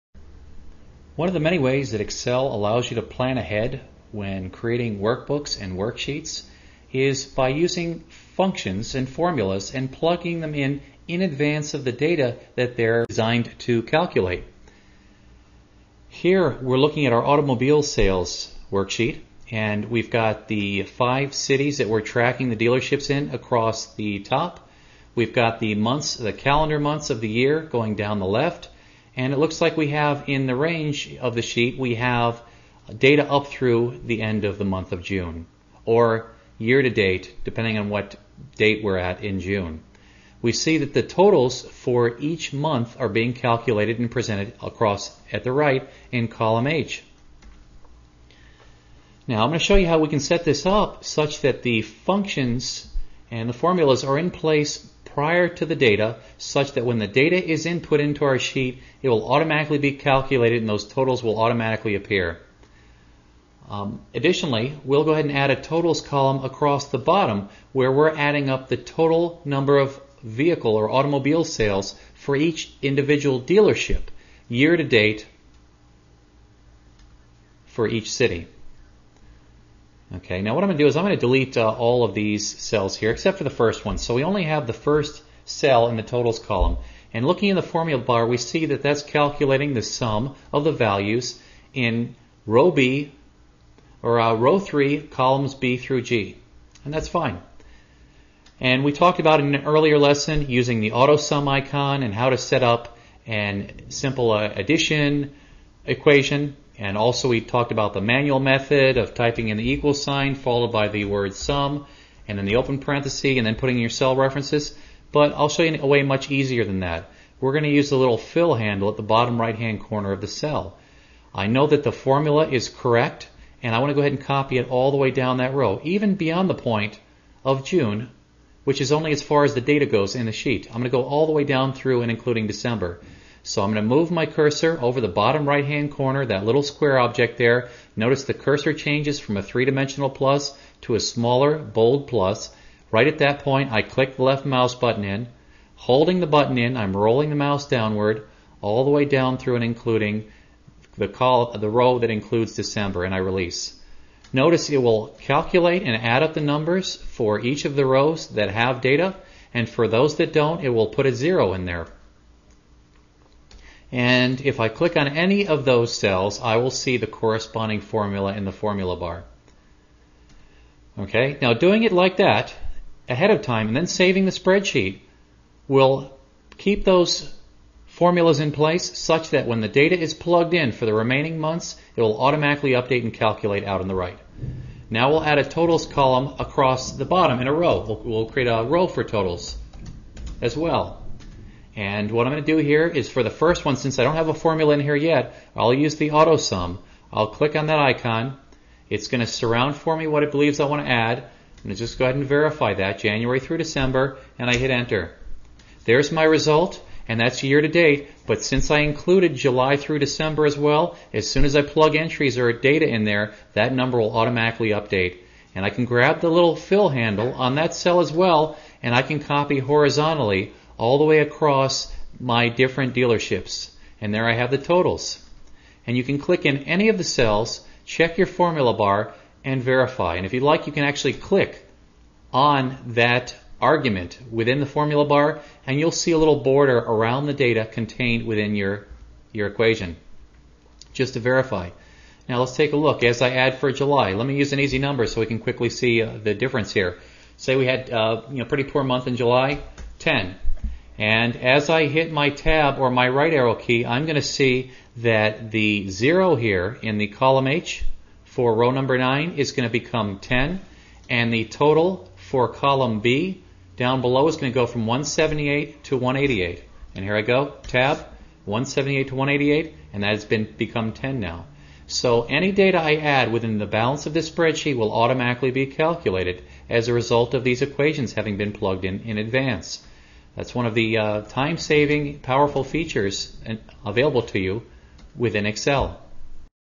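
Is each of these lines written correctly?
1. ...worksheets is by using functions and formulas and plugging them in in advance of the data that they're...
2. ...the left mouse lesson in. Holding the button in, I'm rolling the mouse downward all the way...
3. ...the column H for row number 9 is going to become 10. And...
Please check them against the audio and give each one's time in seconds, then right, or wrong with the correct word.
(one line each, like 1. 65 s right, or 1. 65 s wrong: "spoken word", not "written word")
1. 5 s right
2. 144 s wrong: "button", not "lesson"
3. 256 s right.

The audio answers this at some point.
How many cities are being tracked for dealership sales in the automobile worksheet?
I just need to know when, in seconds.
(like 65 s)
20 s.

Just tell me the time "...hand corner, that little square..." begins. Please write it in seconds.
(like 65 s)
135 s.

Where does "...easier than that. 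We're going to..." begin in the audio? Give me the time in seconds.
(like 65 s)
116 s.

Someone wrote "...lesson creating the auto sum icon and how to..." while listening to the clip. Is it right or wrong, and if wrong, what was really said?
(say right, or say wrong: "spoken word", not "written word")
wrong: "using", not "creating".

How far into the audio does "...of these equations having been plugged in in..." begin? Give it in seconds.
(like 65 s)
277 s.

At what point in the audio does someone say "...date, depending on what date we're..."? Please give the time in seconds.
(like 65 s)
36 s.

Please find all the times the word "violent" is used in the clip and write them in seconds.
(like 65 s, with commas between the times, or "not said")
not said.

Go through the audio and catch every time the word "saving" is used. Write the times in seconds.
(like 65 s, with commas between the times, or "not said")
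173 s, 281 s.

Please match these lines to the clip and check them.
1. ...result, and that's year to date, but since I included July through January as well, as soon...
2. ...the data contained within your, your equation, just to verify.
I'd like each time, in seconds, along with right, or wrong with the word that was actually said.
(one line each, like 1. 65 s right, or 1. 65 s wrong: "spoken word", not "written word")
1. 206 s wrong: "December", not "January"
2. 237 s right.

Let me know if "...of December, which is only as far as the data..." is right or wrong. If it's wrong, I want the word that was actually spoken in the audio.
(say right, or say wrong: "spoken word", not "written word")
wrong: "June", not "December".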